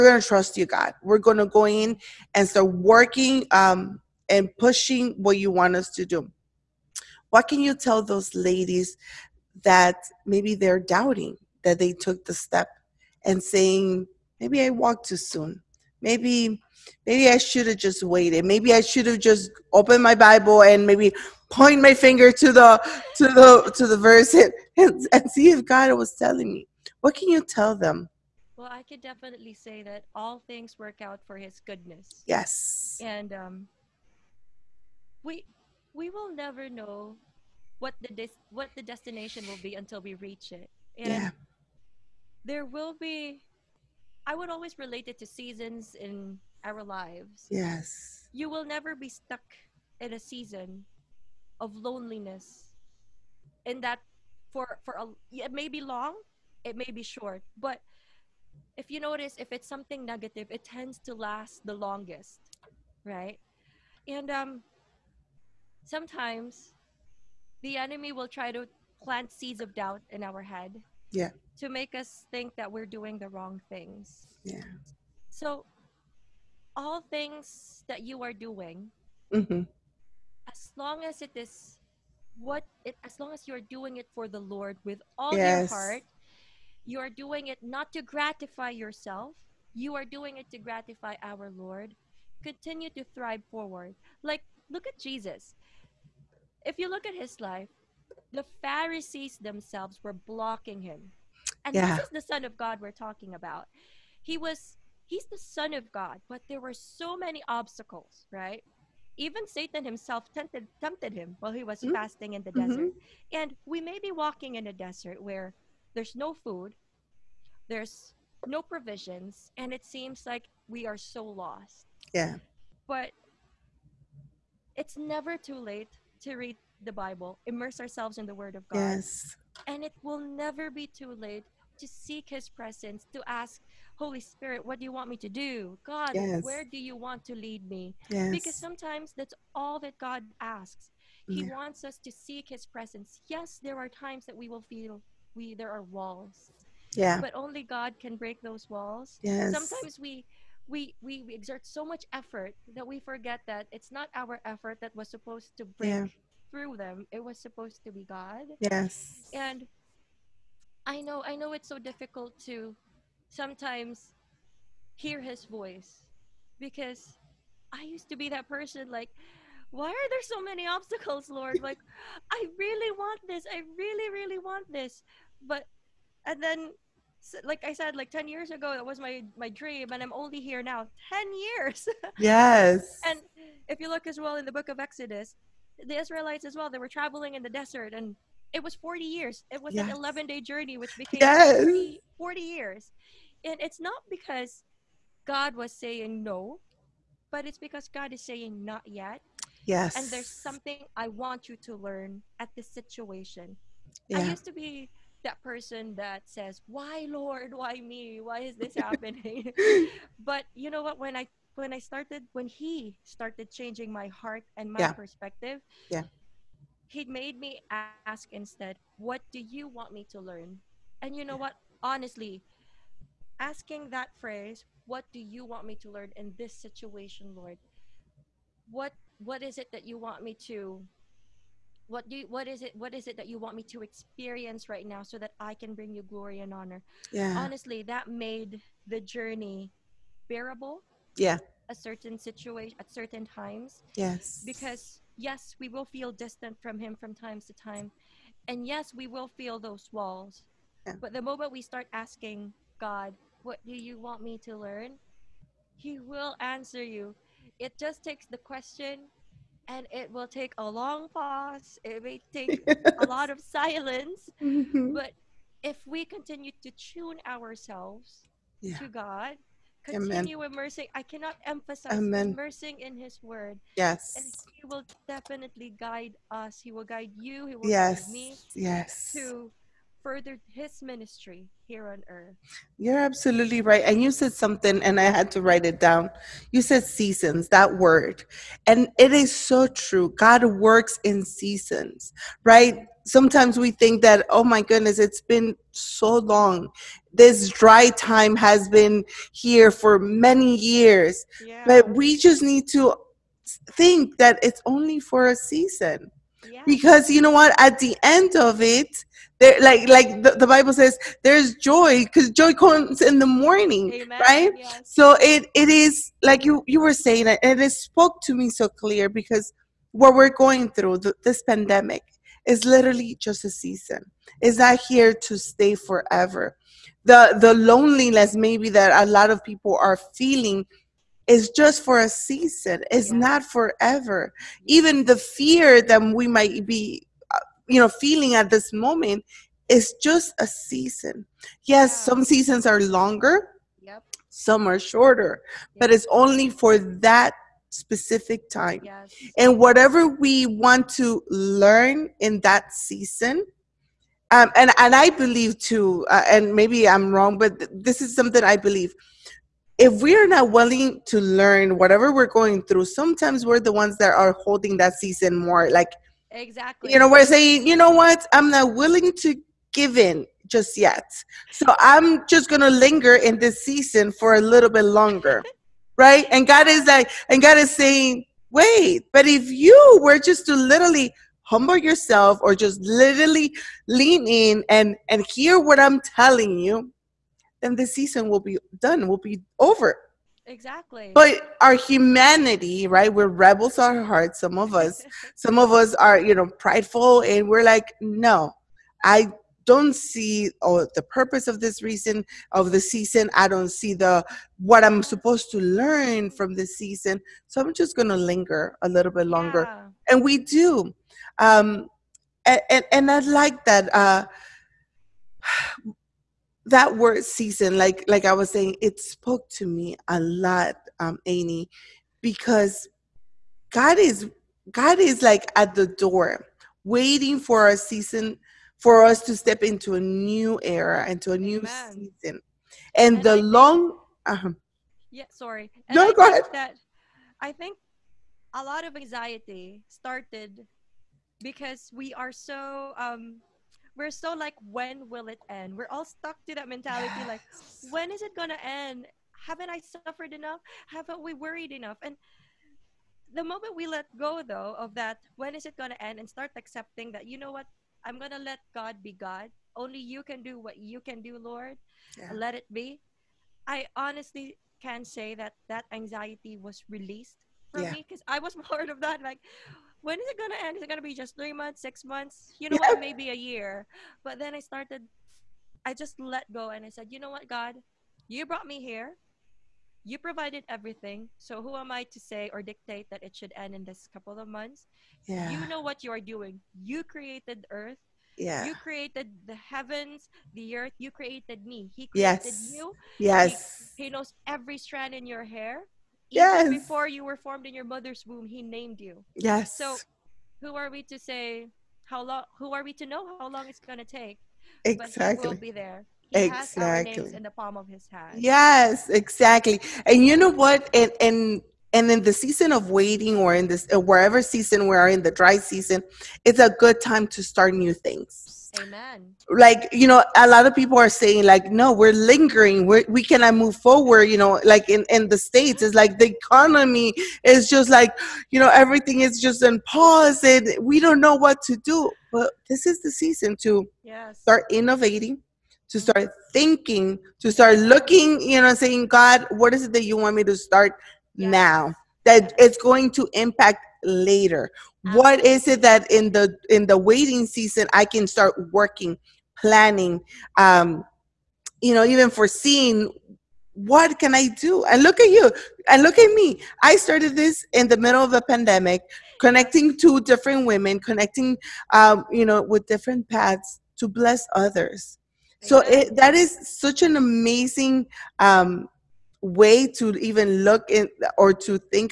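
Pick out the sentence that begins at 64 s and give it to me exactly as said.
And um sometimes the enemy will try to plant seeds of doubt in our head.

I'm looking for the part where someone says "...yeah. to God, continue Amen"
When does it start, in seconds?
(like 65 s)
268 s.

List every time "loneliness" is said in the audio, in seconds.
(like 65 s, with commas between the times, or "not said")
51 s, 327 s.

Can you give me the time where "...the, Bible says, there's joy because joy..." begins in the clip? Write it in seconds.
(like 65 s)
310 s.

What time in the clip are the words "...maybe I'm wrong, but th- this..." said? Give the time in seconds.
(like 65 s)
356 s.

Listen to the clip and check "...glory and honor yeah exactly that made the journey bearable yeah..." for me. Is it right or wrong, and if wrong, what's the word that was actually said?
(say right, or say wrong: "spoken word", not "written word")
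wrong: "honestly", not "exactly".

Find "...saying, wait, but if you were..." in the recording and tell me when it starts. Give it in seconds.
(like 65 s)
377 s.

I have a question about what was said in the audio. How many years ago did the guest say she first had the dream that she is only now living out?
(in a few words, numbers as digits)
10.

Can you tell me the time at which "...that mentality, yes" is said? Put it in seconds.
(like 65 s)
446 s.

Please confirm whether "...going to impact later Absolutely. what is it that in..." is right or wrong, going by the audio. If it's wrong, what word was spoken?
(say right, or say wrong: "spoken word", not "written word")
right.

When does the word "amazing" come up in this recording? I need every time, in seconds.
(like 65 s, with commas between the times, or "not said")
567 s.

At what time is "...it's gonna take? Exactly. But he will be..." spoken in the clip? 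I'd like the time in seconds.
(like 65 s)
503 s.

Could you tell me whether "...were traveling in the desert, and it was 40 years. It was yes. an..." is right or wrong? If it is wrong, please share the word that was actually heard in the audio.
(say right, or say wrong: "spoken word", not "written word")
right.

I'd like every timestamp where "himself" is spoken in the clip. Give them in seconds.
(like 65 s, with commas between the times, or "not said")
109 s.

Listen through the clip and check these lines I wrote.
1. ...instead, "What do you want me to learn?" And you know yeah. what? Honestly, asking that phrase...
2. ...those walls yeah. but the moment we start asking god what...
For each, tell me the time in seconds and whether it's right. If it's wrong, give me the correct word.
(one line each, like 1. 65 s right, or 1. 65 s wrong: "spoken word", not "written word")
1. 218 s right
2. 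249 s right.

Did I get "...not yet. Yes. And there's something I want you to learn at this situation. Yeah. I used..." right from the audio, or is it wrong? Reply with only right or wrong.
right.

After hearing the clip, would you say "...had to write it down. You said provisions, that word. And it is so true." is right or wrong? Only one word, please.
wrong.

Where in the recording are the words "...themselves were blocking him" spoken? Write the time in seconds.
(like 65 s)
99 s.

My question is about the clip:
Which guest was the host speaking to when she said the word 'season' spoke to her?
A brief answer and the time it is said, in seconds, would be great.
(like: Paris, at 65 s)
Amy, at 421 s.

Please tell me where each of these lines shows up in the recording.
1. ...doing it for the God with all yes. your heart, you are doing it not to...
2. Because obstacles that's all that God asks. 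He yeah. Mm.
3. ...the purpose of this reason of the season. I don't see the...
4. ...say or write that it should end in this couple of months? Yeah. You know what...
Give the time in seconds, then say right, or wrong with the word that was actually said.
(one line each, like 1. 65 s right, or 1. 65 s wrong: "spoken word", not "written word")
1. 83 s wrong: "Lord", not "God"
2. 138 s wrong: "sometimes", not "obstacles"
3. 400 s right
4. 482 s wrong: "dictate", not "write".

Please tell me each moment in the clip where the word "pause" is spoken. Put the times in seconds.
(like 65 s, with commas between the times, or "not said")
261 s, 529 s.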